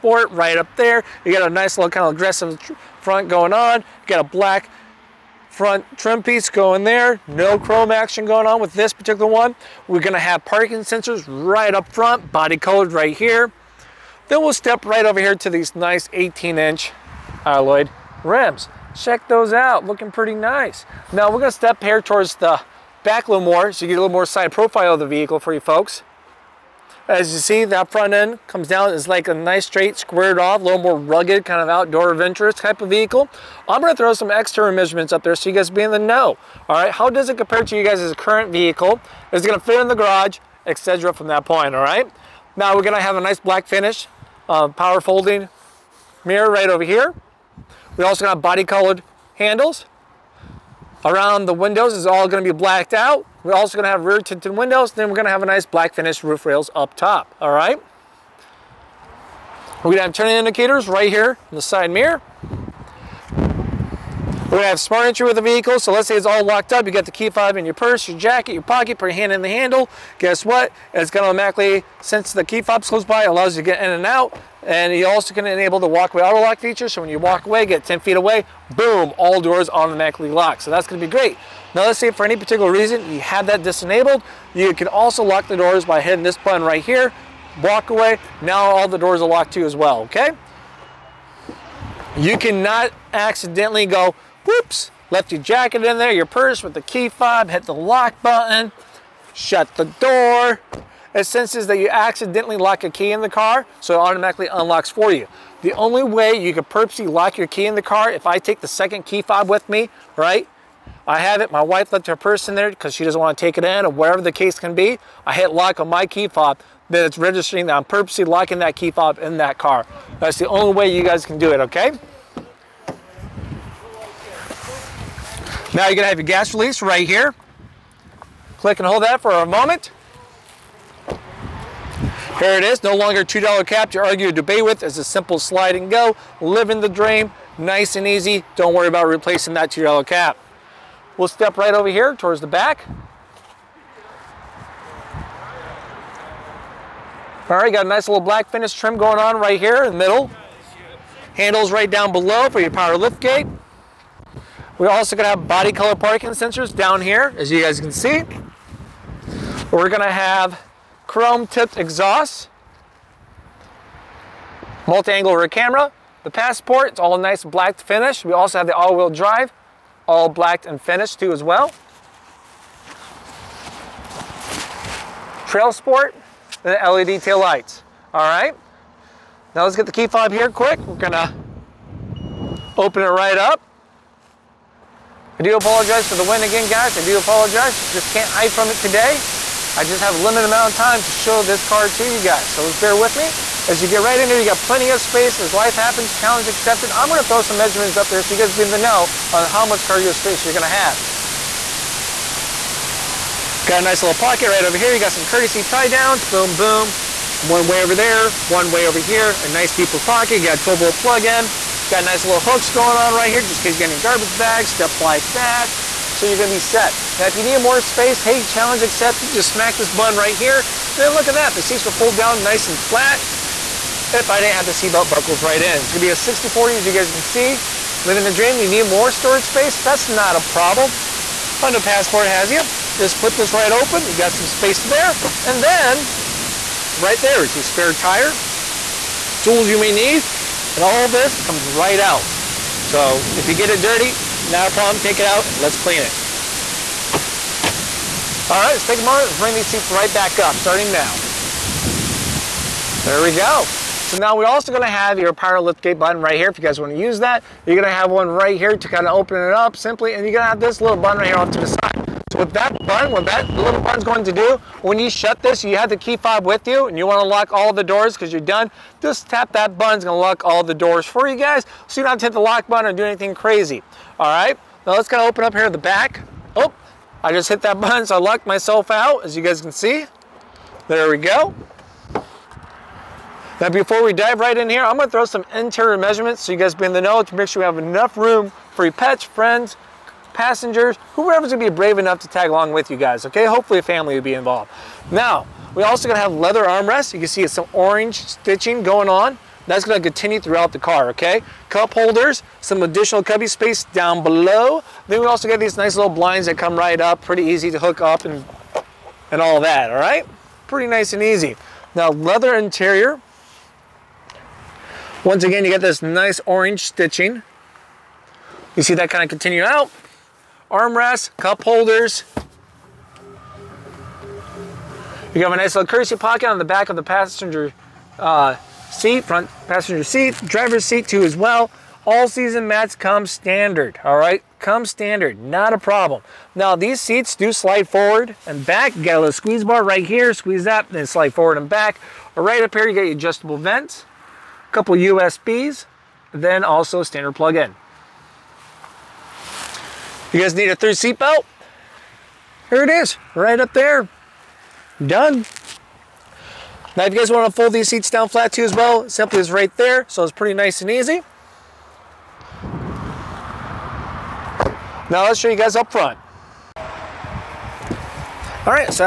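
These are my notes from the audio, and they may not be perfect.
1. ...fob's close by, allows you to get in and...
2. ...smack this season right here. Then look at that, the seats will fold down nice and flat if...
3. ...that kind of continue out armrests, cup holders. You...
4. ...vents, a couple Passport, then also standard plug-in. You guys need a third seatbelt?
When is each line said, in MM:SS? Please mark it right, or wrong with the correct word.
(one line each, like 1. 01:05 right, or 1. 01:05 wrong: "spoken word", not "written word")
1. 01:12 right
2. 03:39 wrong: "button", not "season"
3. 05:18 right
4. 05:43 wrong: "USBs", not "Passport".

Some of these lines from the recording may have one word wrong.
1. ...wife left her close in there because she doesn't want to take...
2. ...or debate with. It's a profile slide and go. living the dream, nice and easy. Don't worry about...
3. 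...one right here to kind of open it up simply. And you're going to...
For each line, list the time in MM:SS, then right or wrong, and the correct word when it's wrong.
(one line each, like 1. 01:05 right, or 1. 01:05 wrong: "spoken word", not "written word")
1. 01:51 wrong: "purse", not "close"
2. 02:14 wrong: "simple", not "profile"
3. 04:18 right.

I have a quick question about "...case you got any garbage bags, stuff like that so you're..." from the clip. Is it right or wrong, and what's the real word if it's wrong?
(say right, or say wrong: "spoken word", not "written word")
right.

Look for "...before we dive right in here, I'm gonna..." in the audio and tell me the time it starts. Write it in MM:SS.
04:43.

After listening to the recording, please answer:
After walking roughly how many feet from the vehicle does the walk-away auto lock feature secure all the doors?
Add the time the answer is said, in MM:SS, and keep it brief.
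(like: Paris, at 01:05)
10 feet, at 01:17.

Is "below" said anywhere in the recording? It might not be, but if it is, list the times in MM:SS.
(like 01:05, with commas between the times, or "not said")
02:32, 05:04.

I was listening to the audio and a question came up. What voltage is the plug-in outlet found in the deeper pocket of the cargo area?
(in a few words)
12 volt.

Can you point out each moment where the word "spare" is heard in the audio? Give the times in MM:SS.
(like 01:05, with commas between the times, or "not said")
03:57.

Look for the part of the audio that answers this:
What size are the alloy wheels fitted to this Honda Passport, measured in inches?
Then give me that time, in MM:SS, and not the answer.
00:16.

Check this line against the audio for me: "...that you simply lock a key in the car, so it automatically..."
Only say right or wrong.
wrong.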